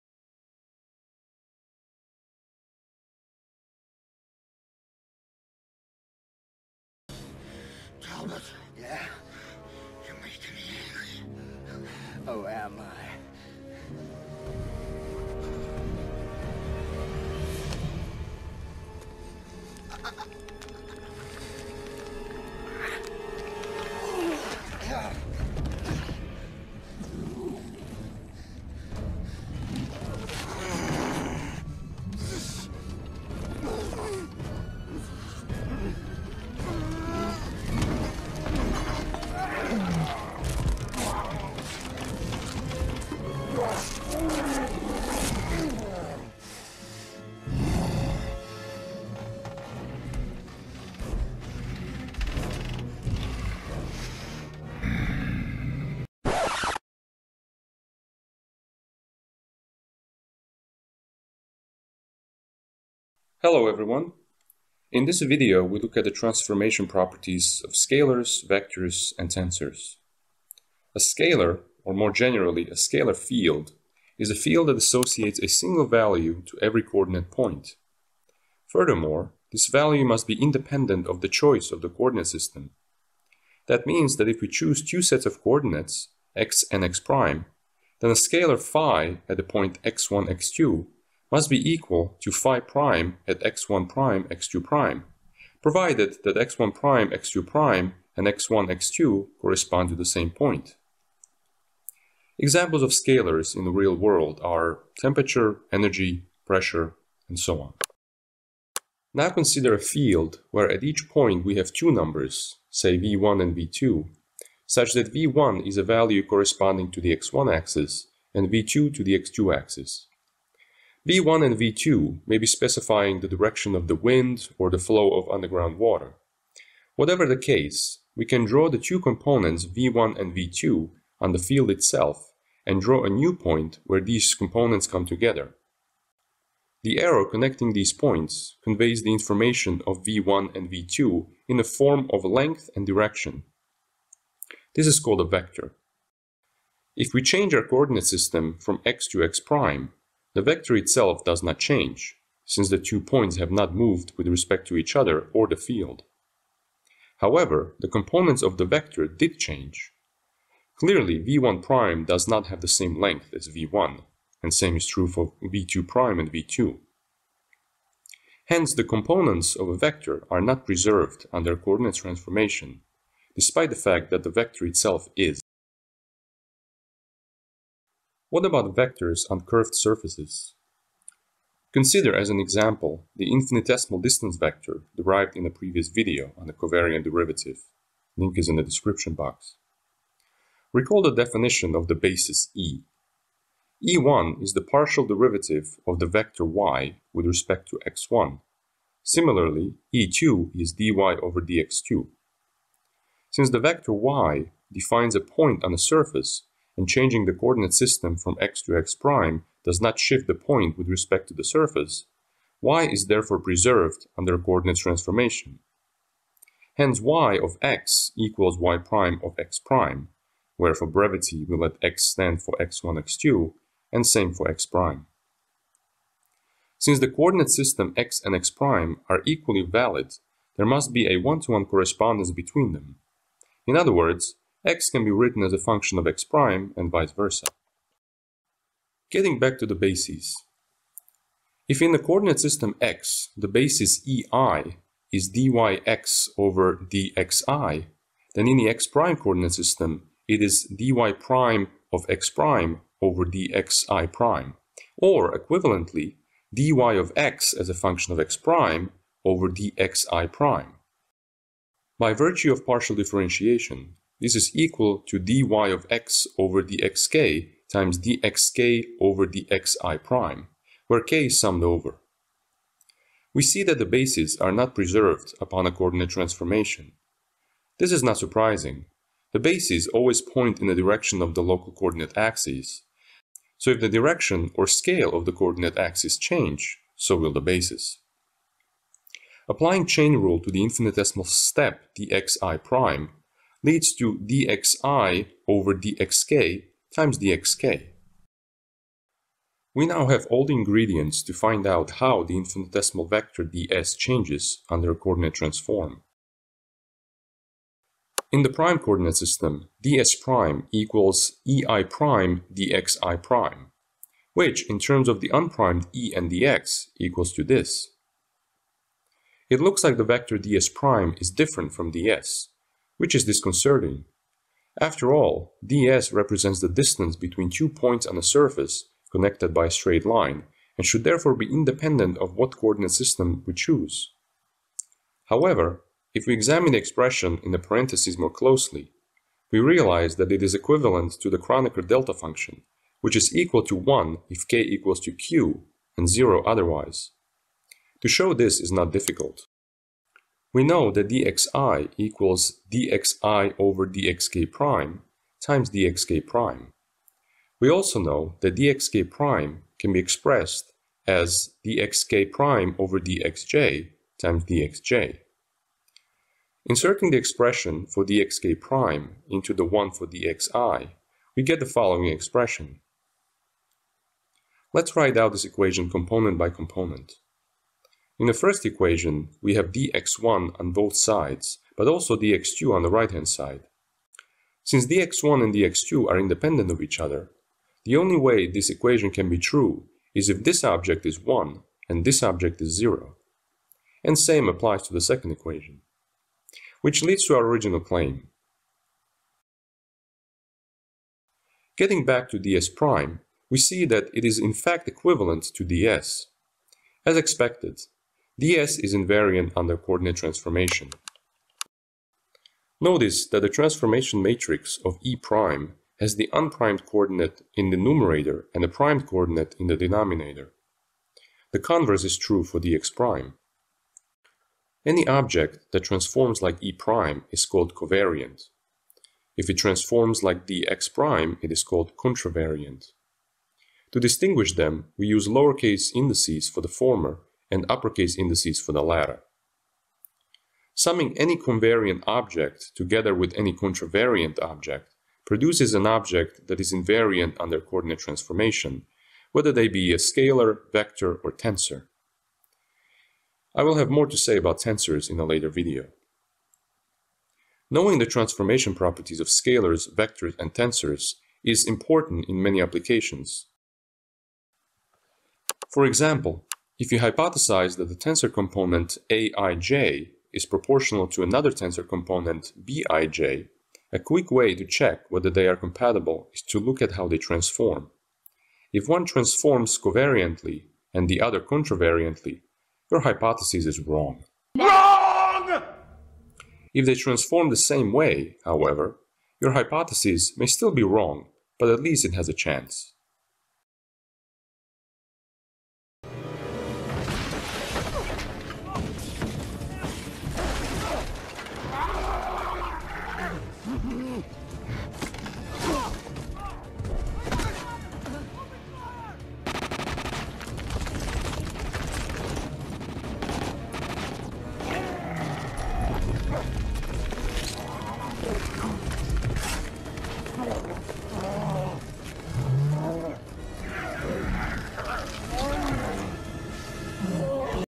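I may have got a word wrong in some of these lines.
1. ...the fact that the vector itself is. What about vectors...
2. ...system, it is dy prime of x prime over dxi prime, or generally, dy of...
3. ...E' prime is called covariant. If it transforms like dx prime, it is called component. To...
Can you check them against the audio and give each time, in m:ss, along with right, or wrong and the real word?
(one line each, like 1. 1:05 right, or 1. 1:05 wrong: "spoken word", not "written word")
1. 2:53 right
2. 4:09 wrong: "equivalently", not "generally"
3. 7:06 wrong: "contravariant", not "component".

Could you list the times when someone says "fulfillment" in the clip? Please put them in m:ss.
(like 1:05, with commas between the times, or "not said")
not said.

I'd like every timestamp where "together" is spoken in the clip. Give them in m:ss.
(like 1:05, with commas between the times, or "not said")
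2:15, 7:22.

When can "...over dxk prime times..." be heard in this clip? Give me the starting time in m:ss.
5:53.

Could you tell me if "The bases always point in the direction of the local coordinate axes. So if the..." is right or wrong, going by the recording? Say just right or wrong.
right.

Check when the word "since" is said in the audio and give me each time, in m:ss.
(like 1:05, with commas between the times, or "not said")
2:32, 3:23, 3:46, 6:24.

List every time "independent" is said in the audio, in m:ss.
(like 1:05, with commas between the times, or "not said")
1:20, 5:31, 6:26.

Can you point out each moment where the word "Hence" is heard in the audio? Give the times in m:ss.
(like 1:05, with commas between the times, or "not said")
2:48, 3:36.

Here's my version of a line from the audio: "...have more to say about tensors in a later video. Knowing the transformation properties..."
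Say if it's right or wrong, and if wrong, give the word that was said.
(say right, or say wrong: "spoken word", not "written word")
right.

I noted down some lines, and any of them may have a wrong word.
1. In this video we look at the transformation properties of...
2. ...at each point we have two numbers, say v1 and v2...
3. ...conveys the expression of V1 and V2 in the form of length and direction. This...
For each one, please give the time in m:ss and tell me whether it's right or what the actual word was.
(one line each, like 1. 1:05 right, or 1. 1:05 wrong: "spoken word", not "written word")
1. 1:04 right
2. 1:50 right
3. 2:18 wrong: "information", not "expression".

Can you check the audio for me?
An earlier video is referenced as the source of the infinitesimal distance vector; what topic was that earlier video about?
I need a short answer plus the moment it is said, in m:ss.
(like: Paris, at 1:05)
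covariant derivative, at 3:06.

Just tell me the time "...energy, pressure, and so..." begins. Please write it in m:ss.
1:45.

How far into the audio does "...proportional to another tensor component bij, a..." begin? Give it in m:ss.
7:50.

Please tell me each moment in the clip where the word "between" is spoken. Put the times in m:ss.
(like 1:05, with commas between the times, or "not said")
3:52, 5:27.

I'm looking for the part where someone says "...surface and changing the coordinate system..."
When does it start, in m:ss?
3:25.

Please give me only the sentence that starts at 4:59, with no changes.
We now have all the ingredients to find out how the infinitesimal vector ds changes under a coordinate transform.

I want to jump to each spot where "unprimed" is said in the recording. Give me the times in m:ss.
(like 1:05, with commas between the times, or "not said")
5:15, 6:56.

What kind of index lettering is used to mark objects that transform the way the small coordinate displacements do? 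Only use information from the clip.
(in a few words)
uppercase indices.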